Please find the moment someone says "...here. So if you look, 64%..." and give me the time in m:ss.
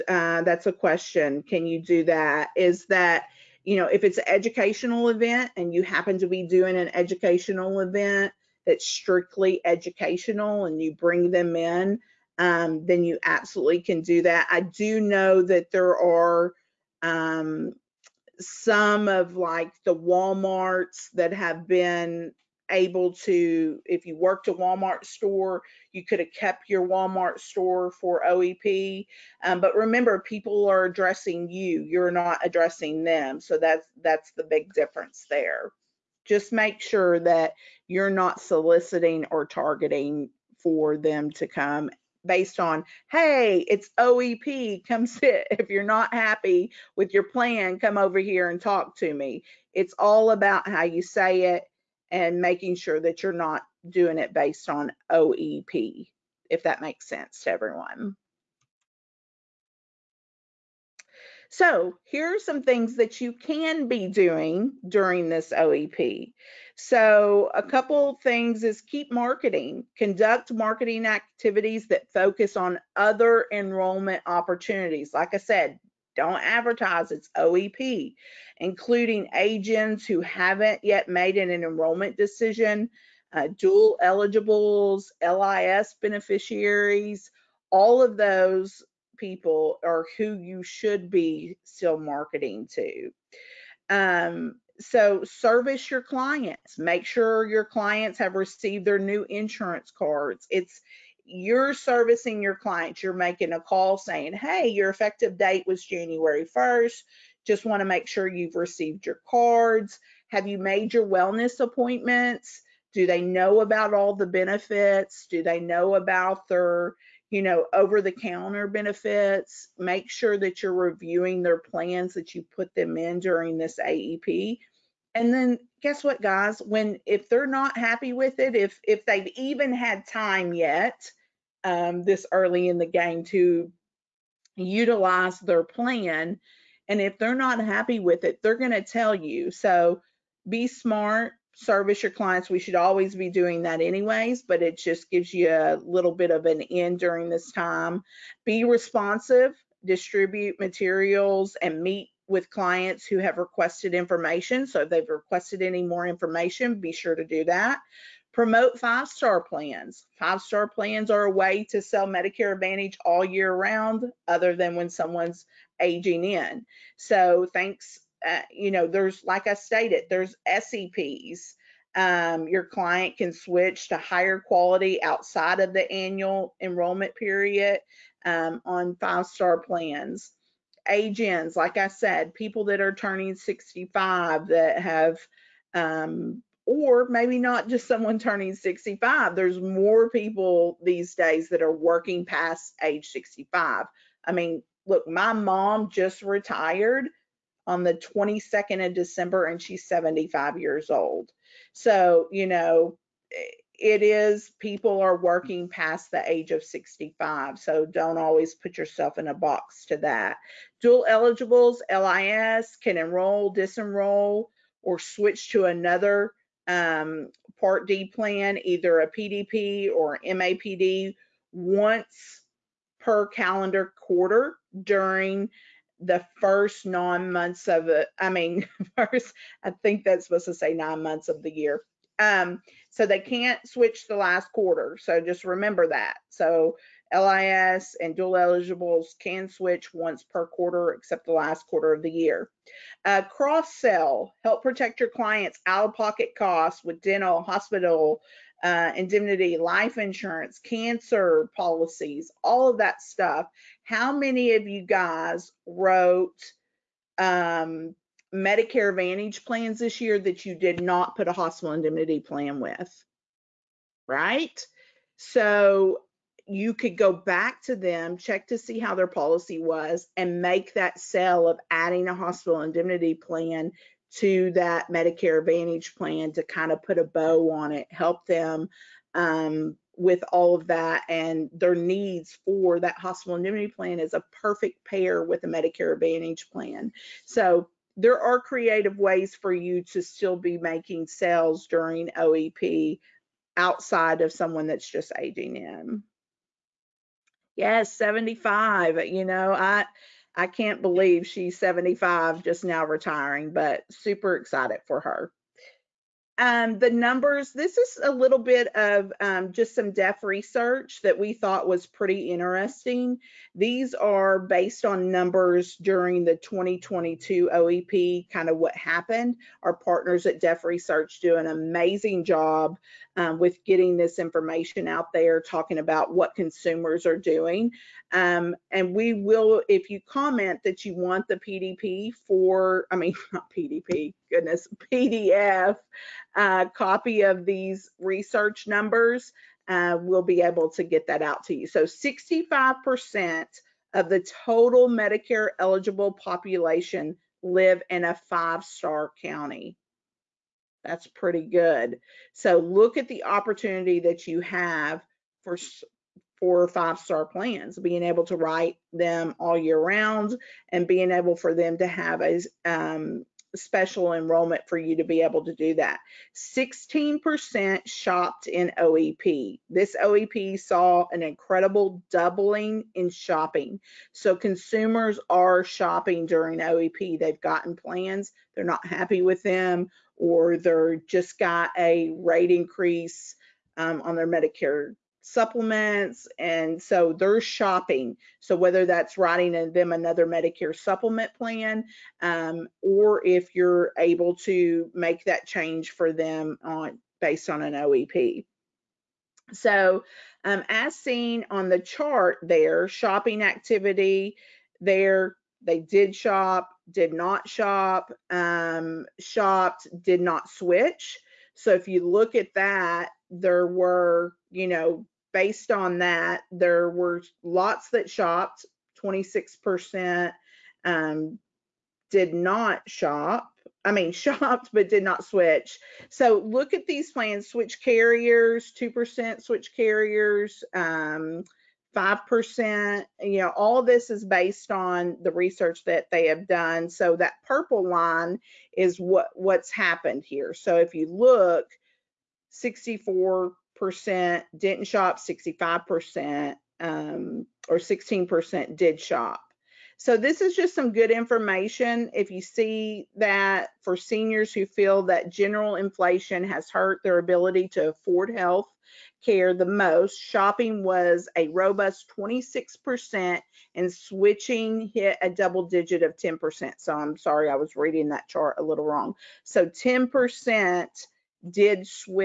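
7:20.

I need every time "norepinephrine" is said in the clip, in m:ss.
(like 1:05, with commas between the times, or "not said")
not said.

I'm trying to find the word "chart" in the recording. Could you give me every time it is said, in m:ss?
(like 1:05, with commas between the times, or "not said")
6:41, 7:48.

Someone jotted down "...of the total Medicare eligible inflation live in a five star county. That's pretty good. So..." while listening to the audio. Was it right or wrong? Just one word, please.
wrong.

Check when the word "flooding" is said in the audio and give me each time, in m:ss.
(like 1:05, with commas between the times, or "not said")
not said.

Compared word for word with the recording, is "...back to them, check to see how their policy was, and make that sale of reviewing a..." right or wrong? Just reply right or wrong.
wrong.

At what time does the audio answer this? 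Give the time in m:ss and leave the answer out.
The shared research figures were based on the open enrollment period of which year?
5:16.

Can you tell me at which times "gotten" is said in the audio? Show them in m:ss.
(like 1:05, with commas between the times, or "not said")
6:17.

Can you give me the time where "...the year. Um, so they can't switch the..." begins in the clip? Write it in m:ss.
3:51.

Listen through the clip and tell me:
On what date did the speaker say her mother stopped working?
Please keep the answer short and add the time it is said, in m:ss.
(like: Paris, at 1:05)
December 22, at 3:17.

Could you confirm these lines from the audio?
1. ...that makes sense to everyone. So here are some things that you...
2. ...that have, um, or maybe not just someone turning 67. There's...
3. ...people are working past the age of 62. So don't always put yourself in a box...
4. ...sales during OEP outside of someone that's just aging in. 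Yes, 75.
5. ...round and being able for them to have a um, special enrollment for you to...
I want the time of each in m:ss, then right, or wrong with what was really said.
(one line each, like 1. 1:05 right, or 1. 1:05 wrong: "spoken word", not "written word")
1. 0:56 right
2. 3:04 wrong: "65", not "67"
3. 3:24 wrong: "65", not "62"
4. 4:51 right
5. 5:59 right.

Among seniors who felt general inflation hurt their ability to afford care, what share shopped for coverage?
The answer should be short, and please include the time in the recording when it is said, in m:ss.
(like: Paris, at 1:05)
26%, at 7:41.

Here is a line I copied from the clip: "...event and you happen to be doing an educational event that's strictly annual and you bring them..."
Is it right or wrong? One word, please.
wrong.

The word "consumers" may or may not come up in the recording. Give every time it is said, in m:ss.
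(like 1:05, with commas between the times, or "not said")
5:26, 6:14.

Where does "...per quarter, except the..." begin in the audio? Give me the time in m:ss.
4:00.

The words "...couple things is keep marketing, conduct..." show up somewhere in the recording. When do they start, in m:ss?
1:07.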